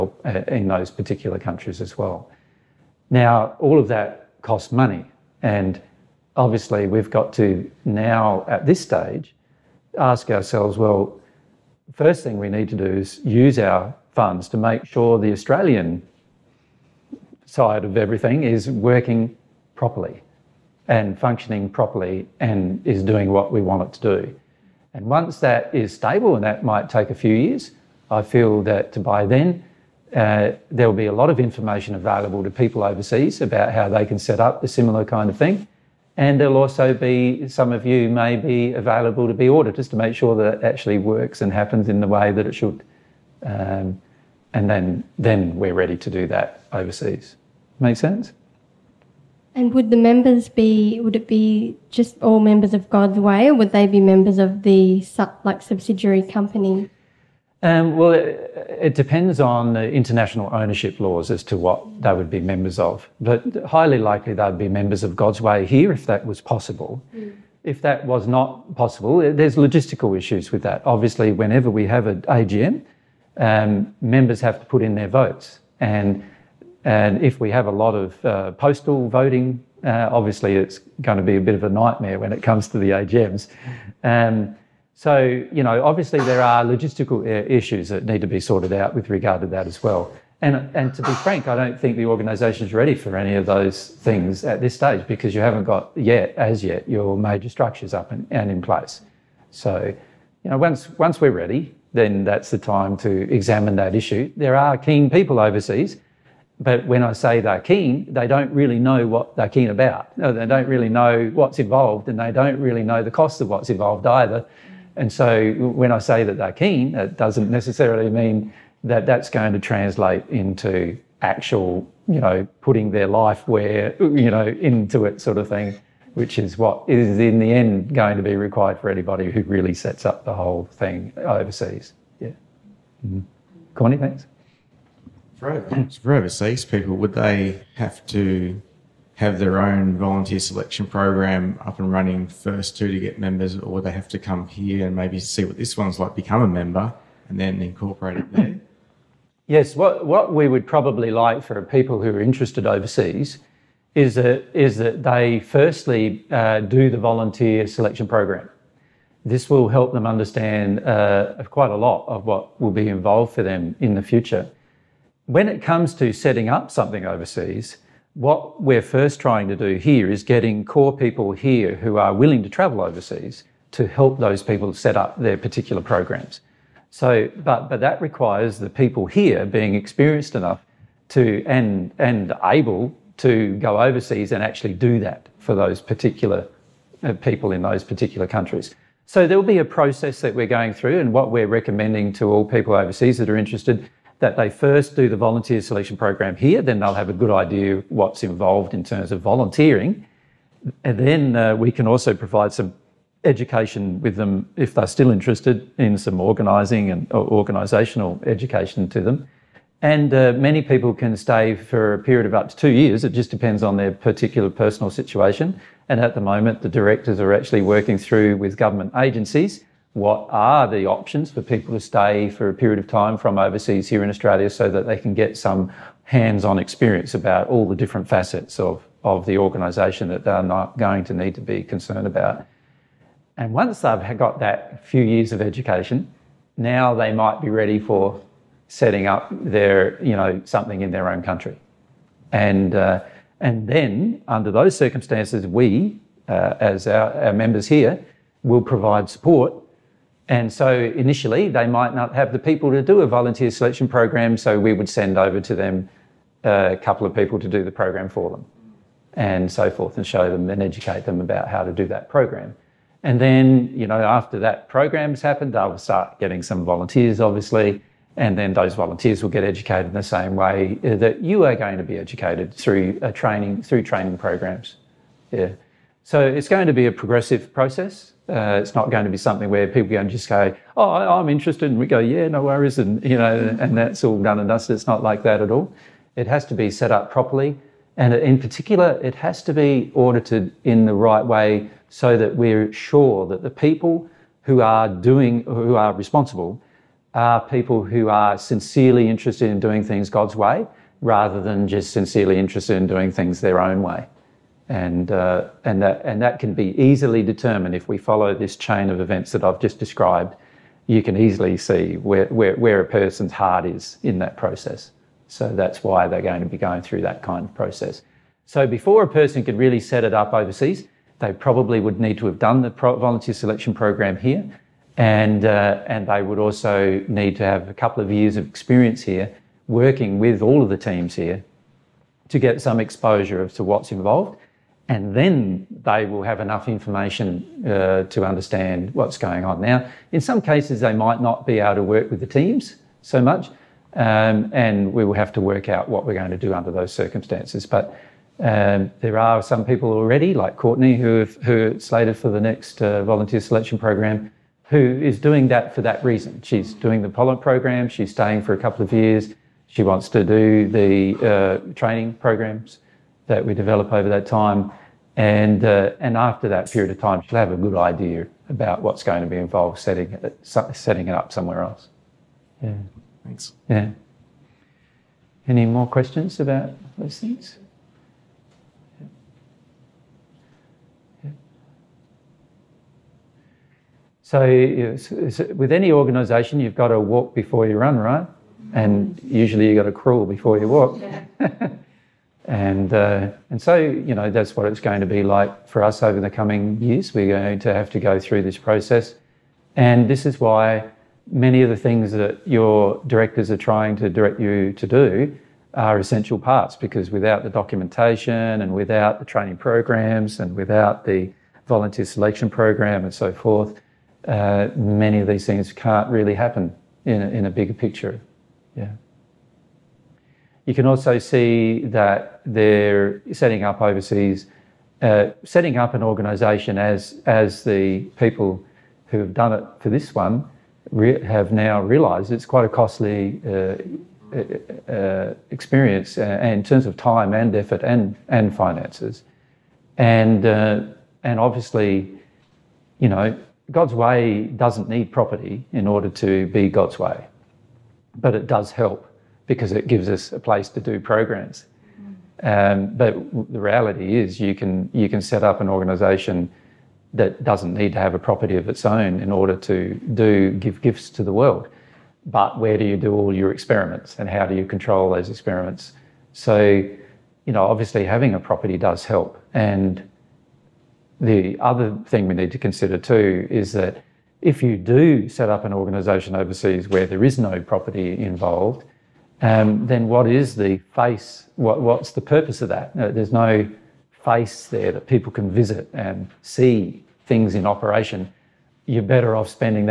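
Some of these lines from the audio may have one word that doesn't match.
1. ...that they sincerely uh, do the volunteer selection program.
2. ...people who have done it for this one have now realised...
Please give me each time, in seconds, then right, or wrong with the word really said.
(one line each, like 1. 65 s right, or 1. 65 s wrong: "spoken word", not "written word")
1. 154 s wrong: "firstly", not "sincerely"
2. 428 s right.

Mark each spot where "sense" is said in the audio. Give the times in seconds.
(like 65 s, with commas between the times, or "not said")
47 s.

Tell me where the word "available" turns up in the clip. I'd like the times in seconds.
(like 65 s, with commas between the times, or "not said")
31 s, 38 s.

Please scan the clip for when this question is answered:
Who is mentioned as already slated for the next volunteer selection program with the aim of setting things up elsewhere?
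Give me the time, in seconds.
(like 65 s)
350 s.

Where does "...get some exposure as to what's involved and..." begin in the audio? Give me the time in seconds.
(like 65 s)
332 s.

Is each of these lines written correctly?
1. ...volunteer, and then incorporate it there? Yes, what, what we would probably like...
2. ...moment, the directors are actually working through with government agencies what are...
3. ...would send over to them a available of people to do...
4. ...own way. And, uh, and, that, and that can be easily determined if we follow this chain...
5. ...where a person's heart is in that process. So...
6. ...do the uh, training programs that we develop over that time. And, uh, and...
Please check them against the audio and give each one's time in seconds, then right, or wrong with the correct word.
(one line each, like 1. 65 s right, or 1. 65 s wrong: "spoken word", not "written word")
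1. 146 s wrong: "member", not "volunteer"
2. 216 s right
3. 254 s wrong: "couple", not "available"
4. 303 s right
5. 312 s right
6. 360 s right.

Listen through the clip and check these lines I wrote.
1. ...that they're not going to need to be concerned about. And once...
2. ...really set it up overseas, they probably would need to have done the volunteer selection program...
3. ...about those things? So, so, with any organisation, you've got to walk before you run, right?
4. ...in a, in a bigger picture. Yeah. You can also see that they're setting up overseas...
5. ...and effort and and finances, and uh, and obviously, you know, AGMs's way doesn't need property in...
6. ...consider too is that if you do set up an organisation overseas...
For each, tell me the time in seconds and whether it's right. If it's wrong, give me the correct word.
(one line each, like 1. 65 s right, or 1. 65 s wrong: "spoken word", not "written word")
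1. 230 s right
2. 319 s right
3. 376 s right
4. 417 s right
5. 437 s wrong: "God", not "AGMs"
6. 472 s right.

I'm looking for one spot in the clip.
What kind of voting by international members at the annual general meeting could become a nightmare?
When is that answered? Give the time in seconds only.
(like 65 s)
78 s.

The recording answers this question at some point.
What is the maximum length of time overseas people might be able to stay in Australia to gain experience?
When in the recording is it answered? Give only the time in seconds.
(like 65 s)
212 s.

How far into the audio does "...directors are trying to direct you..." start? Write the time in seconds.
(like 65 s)
403 s.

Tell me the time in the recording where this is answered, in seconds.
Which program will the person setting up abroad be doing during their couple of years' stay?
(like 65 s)
357 s.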